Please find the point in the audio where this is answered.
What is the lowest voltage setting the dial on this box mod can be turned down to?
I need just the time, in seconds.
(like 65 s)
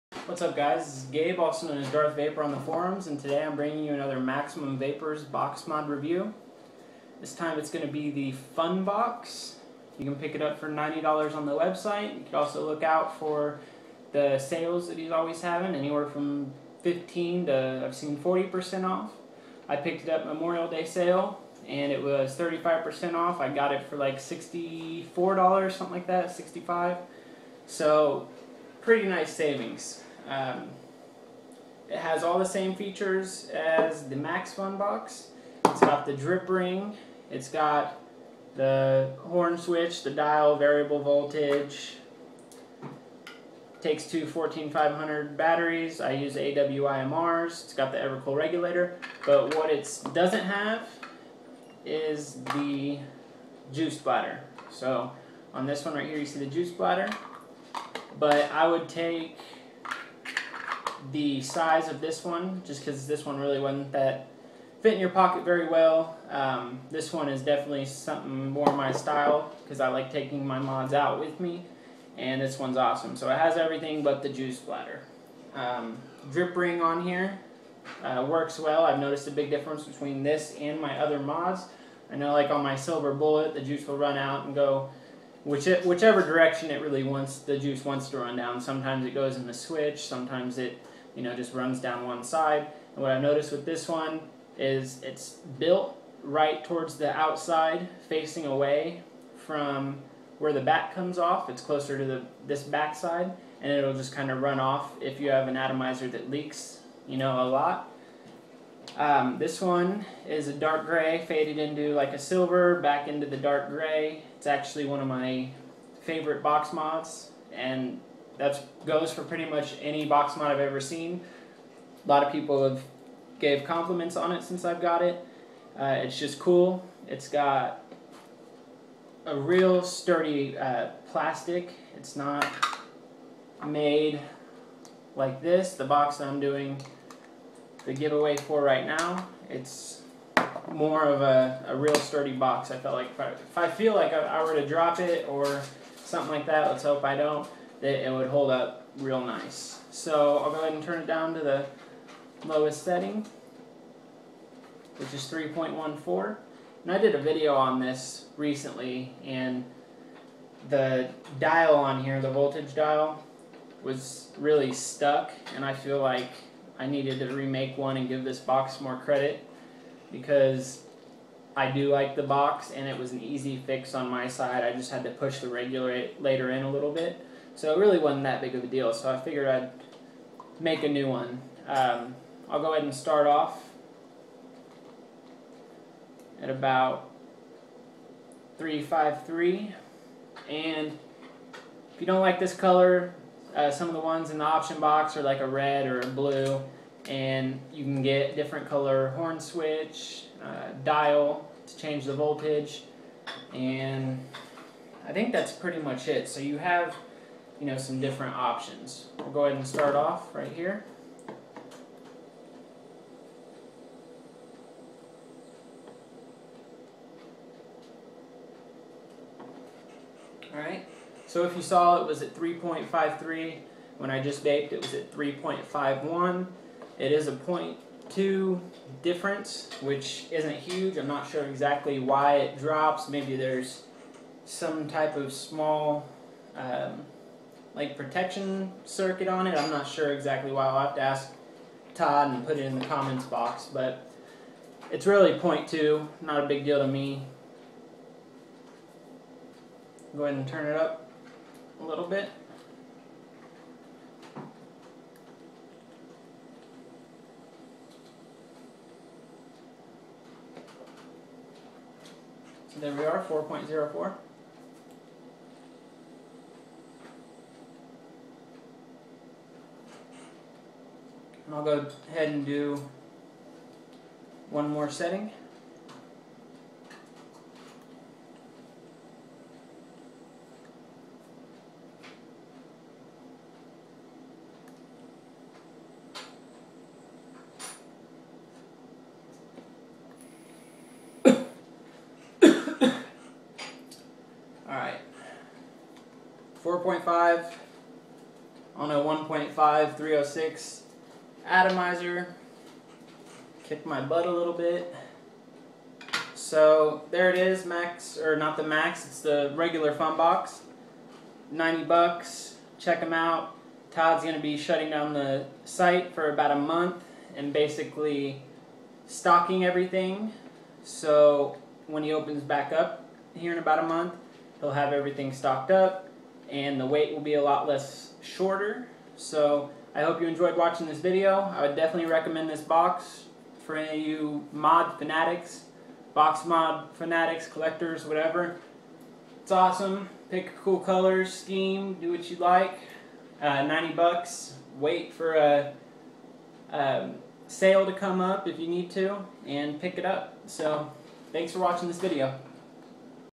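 155 s.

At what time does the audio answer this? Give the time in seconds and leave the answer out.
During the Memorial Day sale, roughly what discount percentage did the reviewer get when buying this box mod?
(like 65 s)
22 s.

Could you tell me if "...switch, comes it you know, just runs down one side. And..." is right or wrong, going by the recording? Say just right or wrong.
wrong.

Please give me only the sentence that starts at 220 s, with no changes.
Alright, so if you saw it was at 3.53, when I just baked it was at 3.51.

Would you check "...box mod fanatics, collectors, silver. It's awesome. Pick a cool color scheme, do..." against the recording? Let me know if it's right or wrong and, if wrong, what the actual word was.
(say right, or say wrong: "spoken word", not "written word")
wrong: "whatever", not "silver".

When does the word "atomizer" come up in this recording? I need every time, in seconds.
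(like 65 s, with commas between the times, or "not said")
105 s, 301 s.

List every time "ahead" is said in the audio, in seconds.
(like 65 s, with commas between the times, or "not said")
150 s, 182 s, 209 s, 250 s, 272 s.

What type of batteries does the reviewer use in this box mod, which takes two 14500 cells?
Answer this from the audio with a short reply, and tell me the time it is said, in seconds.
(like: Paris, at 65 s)
AWIMRs, at 46 s.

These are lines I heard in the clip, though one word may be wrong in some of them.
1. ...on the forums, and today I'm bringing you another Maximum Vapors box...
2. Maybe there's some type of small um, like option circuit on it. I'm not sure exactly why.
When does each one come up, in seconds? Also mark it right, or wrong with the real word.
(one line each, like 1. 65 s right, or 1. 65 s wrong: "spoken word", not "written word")
1. 2 s right
2. 233 s wrong: "protection", not "option".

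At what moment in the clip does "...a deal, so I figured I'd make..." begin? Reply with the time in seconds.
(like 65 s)
178 s.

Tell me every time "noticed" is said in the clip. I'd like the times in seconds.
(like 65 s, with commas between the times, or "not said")
78 s, 93 s.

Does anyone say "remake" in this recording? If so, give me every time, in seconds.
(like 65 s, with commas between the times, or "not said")
167 s.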